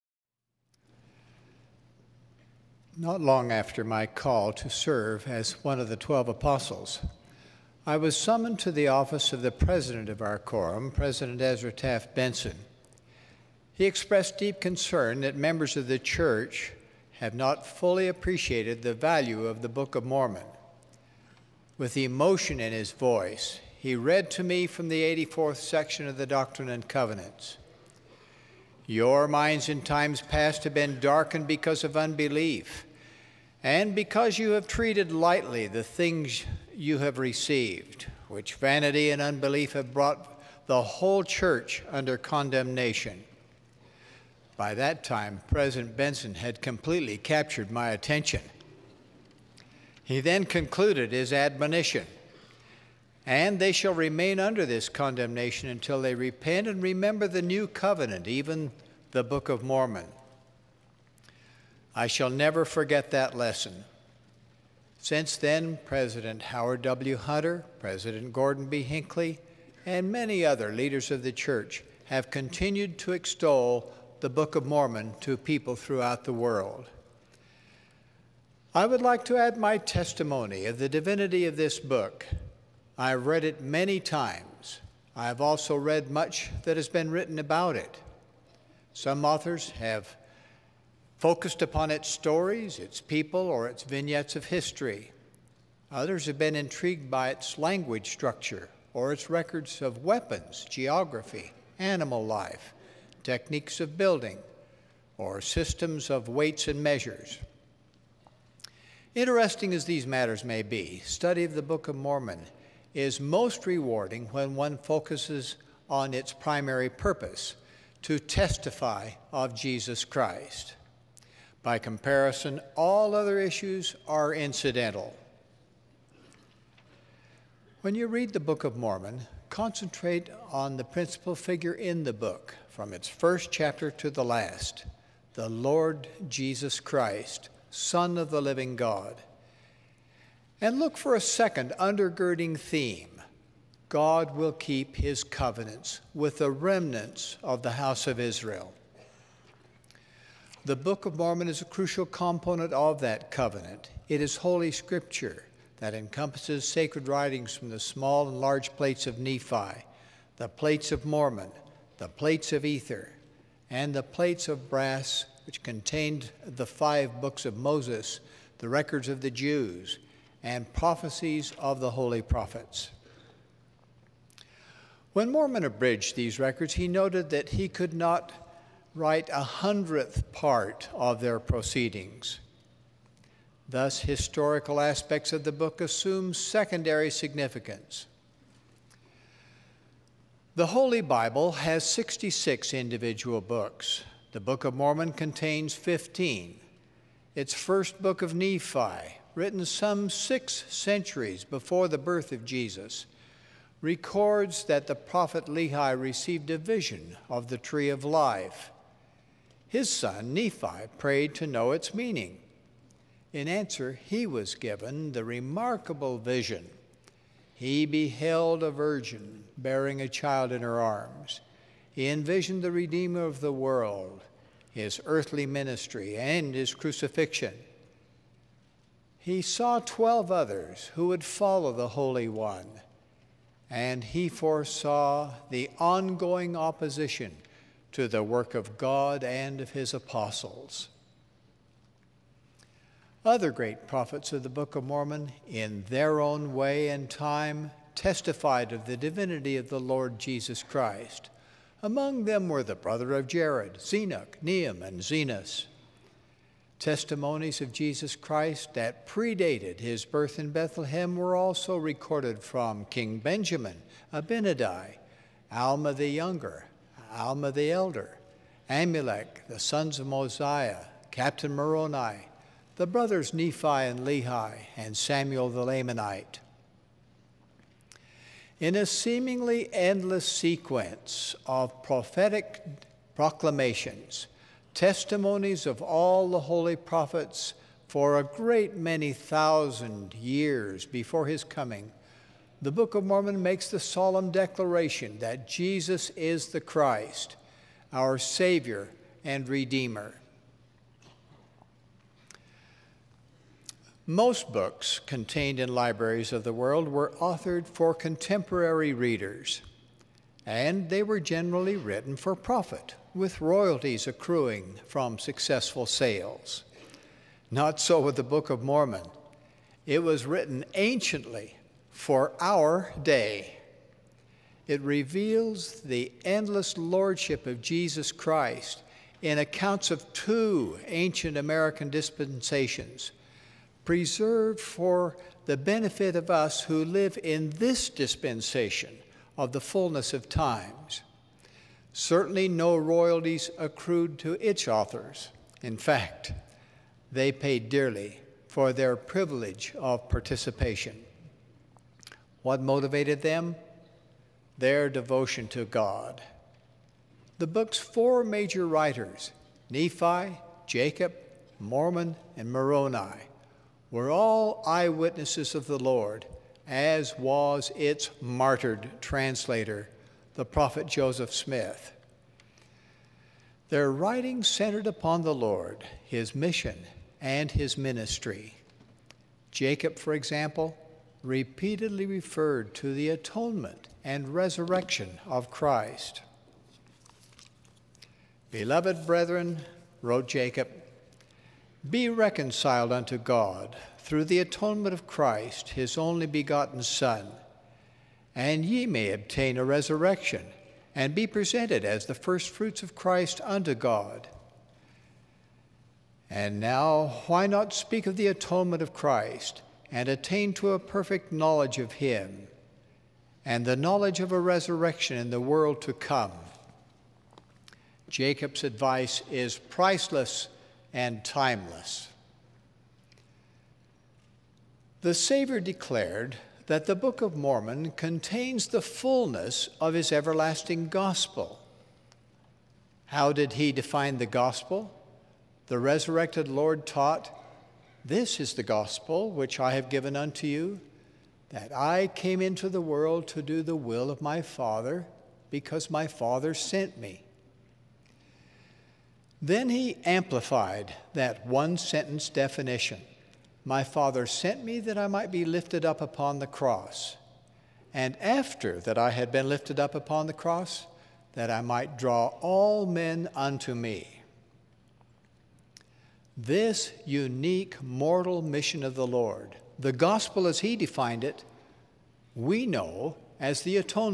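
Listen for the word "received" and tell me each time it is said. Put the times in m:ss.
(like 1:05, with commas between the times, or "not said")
0:37, 3:26.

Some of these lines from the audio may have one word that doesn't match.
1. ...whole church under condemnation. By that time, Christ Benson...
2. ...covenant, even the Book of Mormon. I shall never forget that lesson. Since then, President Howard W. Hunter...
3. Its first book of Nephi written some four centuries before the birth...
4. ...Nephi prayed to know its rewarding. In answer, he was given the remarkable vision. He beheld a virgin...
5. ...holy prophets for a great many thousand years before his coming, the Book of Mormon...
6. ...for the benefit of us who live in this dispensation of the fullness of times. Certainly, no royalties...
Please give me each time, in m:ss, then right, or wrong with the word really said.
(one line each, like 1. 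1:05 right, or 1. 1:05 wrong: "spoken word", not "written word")
1. 0:40 wrong: "President", not "Christ"
2. 0:57 right
3. 3:17 wrong: "six", not "four"
4. 3:30 wrong: "meaning", not "rewarding"
5. 4:46 right
6. 5:34 right.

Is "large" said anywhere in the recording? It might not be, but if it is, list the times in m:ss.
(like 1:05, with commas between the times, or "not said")
2:38.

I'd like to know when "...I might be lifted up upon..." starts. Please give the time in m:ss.
7:34.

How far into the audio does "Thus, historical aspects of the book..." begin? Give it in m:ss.
3:03.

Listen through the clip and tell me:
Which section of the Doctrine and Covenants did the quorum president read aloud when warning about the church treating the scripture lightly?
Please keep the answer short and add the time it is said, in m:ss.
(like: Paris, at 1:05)
84th, at 0:25.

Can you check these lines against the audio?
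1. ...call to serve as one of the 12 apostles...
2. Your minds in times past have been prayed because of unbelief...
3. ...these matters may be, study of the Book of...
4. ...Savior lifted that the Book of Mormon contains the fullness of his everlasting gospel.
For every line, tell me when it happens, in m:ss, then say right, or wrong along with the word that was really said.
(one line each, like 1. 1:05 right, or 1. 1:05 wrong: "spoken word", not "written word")
1. 0:04 right
2. 0:28 wrong: "darkened", not "prayed"
3. 1:49 right
4. 7:05 wrong: "declared", not "lifted".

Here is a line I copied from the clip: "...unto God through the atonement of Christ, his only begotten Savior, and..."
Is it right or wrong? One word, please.
wrong.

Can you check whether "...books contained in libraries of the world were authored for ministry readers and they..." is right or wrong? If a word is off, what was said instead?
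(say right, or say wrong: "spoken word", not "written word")
wrong: "contemporary", not "ministry".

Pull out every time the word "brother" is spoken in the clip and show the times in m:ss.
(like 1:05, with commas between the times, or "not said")
4:12, 4:32.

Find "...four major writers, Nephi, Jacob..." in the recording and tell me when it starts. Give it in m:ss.
5:57.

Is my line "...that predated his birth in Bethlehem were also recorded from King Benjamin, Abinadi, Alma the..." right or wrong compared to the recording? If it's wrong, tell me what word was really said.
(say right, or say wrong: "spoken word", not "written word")
right.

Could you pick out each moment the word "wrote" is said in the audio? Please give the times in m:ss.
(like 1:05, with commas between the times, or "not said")
6:30.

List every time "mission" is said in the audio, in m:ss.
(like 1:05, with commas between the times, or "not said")
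6:16, 7:48.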